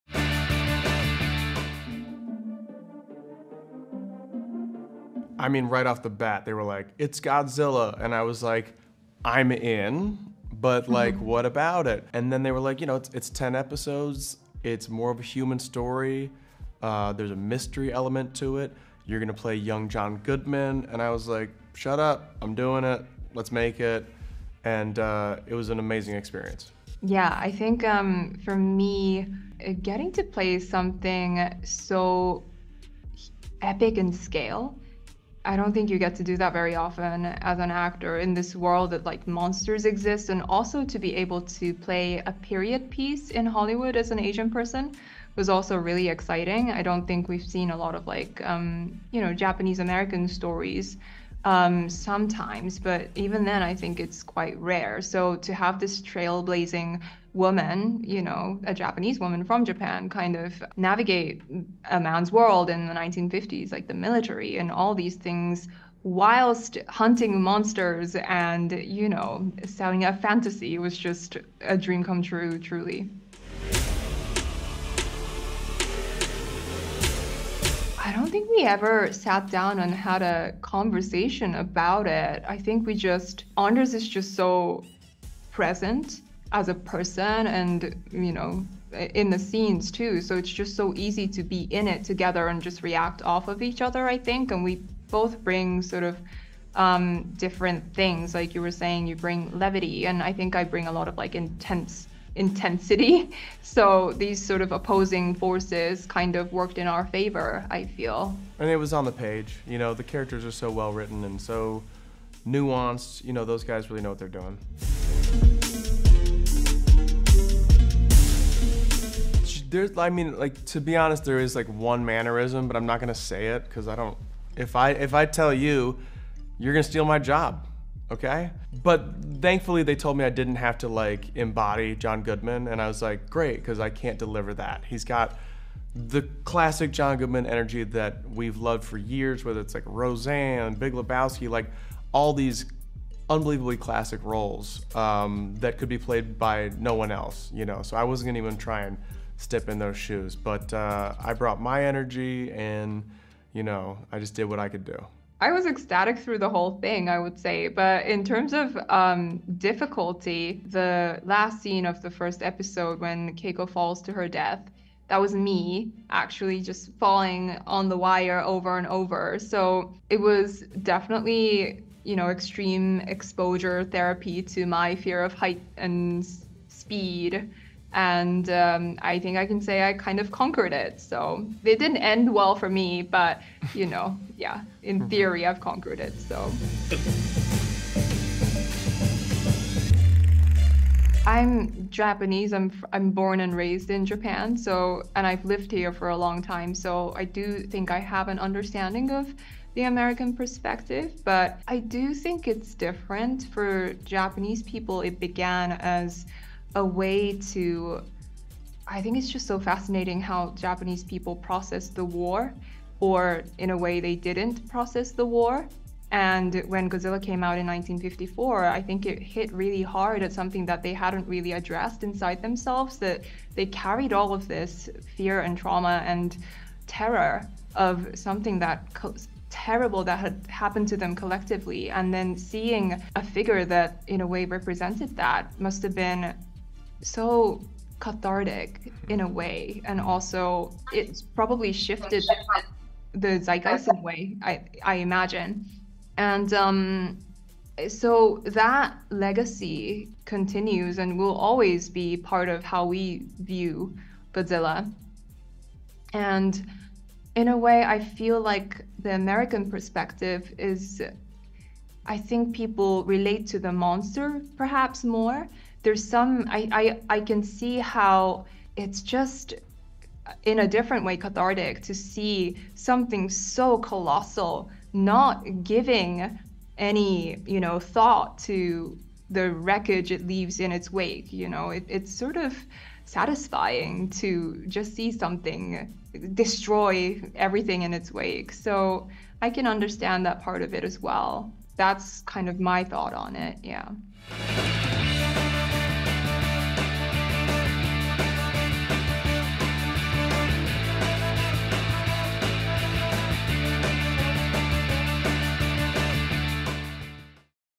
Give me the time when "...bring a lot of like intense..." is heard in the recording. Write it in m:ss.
1:40.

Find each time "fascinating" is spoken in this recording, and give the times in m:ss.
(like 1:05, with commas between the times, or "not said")
3:29.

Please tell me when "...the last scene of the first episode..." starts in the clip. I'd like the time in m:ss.
2:40.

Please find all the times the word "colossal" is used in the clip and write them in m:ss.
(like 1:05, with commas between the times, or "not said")
4:33.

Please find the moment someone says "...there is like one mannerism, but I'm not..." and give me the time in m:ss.
2:01.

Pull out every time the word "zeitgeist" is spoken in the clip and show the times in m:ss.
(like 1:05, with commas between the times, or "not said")
4:03.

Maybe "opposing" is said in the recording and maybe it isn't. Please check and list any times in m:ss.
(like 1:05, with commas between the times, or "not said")
1:44.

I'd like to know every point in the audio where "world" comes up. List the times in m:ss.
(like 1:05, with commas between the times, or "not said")
0:38, 1:02.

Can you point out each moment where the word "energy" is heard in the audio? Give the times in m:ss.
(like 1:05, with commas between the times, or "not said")
2:17, 2:31.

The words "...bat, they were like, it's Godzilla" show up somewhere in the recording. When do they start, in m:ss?
0:06.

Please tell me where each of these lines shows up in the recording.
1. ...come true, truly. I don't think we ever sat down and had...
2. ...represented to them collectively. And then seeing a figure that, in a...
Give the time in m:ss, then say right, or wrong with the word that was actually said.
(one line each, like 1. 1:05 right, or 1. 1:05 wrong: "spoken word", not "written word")
1. 1:12 right
2. 3:50 wrong: "happened", not "represented".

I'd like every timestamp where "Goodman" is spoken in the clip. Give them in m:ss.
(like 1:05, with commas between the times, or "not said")
0:20, 2:12, 2:17.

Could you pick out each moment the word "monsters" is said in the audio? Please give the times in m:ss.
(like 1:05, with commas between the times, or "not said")
0:39, 1:07, 4:23.